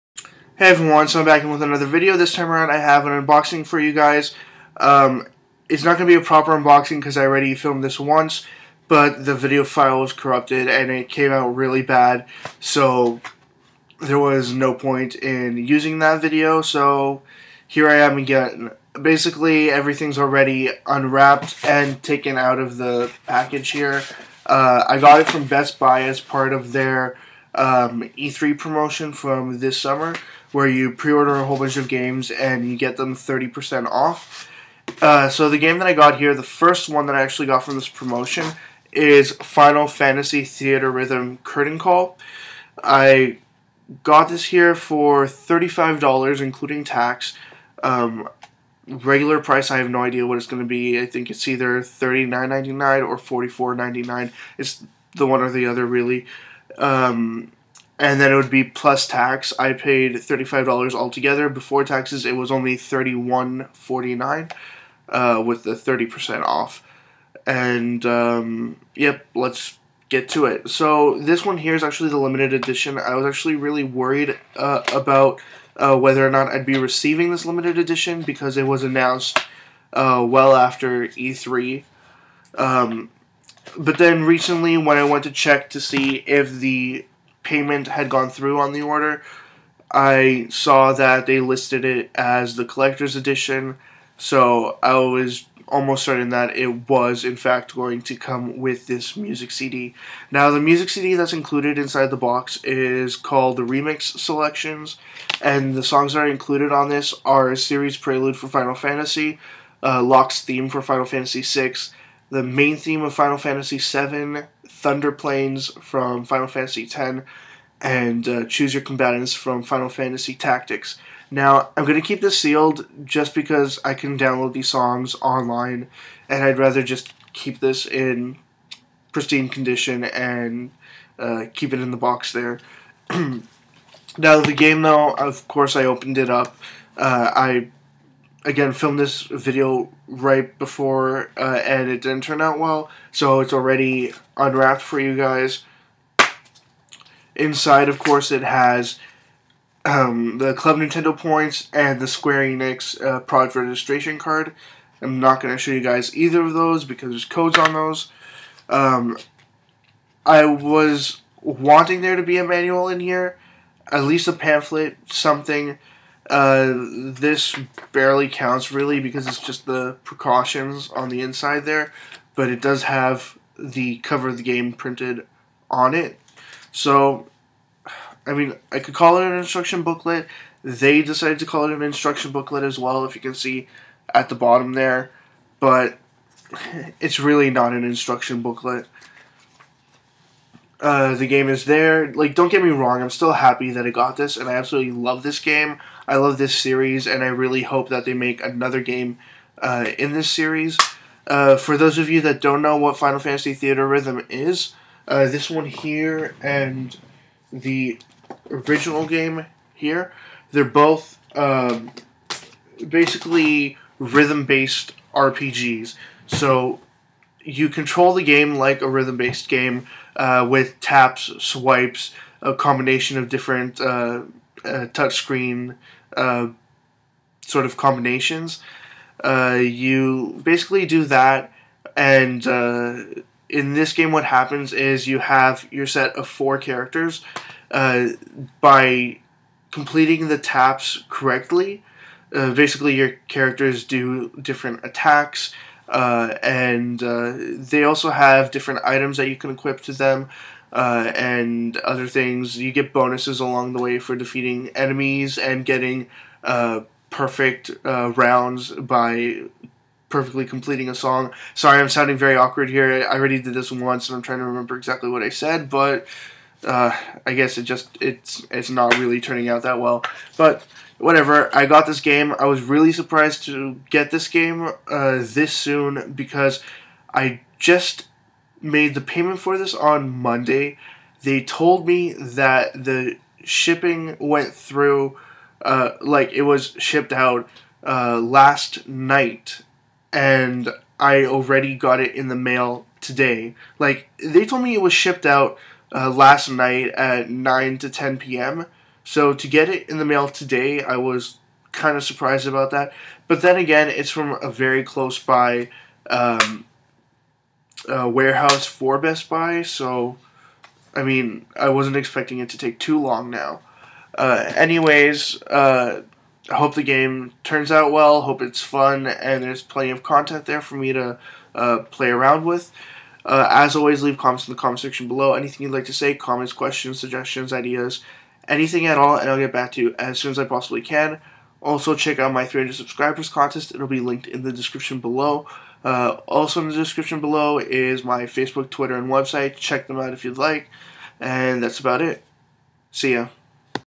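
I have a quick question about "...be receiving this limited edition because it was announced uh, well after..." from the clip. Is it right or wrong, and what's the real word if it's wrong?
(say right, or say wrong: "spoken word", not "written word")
right.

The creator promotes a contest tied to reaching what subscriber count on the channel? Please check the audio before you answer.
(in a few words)
300.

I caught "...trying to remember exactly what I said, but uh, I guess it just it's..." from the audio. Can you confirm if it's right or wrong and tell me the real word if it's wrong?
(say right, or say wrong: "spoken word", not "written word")
right.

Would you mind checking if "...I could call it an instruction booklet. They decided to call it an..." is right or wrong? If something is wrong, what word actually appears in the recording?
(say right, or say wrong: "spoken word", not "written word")
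right.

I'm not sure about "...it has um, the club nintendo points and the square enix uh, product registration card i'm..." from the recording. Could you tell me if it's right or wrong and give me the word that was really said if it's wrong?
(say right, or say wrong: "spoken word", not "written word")
right.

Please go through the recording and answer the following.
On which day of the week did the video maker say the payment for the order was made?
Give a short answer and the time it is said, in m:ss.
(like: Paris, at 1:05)
Monday, at 4:40.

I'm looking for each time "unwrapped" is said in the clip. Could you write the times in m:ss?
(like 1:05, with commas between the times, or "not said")
0:20, 2:24.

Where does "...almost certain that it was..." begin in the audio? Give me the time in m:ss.
1:35.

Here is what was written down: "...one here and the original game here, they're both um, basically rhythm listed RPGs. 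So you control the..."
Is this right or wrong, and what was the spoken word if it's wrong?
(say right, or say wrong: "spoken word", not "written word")
wrong: "based", not "listed".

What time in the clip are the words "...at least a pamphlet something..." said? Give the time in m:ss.
2:43.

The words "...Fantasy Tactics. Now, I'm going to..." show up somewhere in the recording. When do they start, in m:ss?
1:59.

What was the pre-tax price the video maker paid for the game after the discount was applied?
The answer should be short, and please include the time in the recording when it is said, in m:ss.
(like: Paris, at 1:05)
$31.49, at 1:02.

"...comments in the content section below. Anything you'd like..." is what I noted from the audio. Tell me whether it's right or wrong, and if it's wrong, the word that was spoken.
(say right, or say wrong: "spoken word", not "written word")
wrong: "comment", not "content".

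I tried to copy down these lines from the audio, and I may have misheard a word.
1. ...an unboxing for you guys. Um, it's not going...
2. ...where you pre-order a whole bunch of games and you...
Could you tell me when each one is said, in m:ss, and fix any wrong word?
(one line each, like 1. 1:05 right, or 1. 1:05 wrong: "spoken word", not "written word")
1. 0:03 right
2. 0:30 right.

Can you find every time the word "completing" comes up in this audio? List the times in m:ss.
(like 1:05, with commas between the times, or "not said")
3:59, 4:20.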